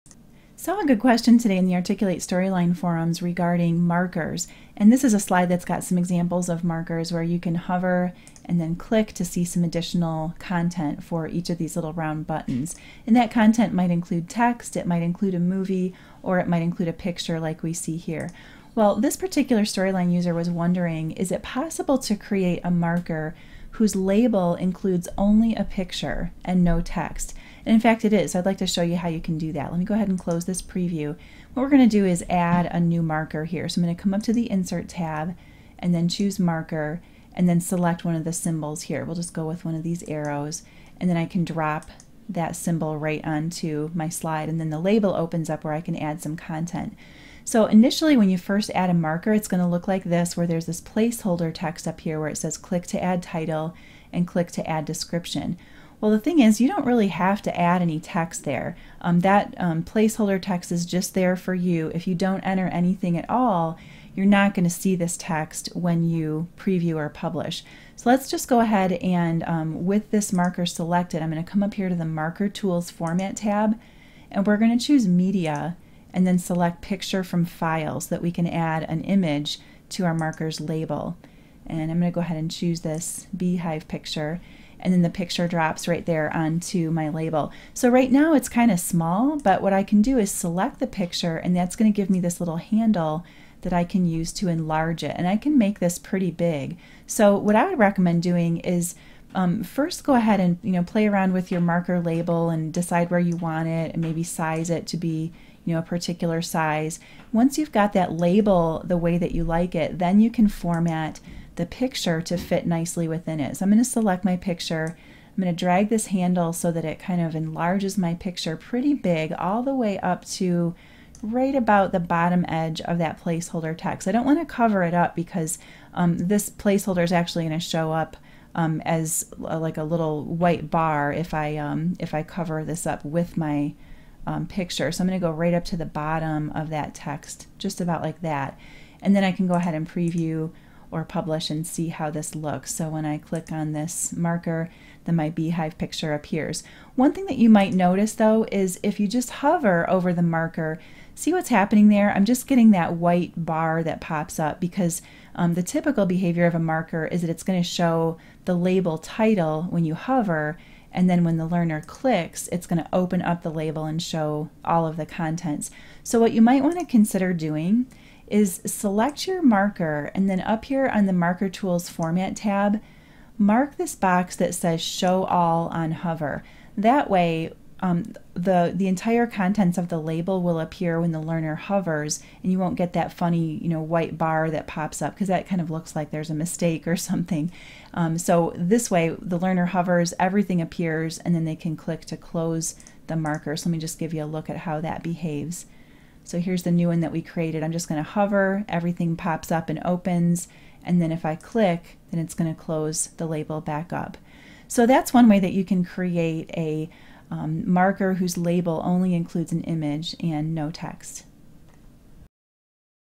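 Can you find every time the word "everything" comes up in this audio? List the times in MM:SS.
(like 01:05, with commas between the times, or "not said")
03:10, 03:18.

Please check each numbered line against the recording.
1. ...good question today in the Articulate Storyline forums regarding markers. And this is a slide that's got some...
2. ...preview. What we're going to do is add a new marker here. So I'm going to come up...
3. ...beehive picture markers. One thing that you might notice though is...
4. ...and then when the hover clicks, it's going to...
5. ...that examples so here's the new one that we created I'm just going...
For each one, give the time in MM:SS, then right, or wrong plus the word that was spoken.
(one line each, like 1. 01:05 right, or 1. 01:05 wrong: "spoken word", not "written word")
1. 00:00 right
2. 00:30 right
3. 02:25 wrong: "appears", not "markers"
4. 02:40 wrong: "learner", not "hover"
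5. 03:14 wrong: "behaves", not "examples".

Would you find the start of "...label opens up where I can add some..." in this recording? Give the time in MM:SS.
00:44.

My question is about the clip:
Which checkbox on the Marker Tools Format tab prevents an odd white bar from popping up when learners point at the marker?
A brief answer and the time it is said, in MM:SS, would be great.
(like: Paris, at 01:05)
Show All on Hover, at 02:54.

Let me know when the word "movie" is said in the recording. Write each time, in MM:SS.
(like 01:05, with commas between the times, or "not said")
00:15.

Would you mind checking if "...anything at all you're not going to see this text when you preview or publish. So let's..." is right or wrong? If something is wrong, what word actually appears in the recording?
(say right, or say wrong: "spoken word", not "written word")
right.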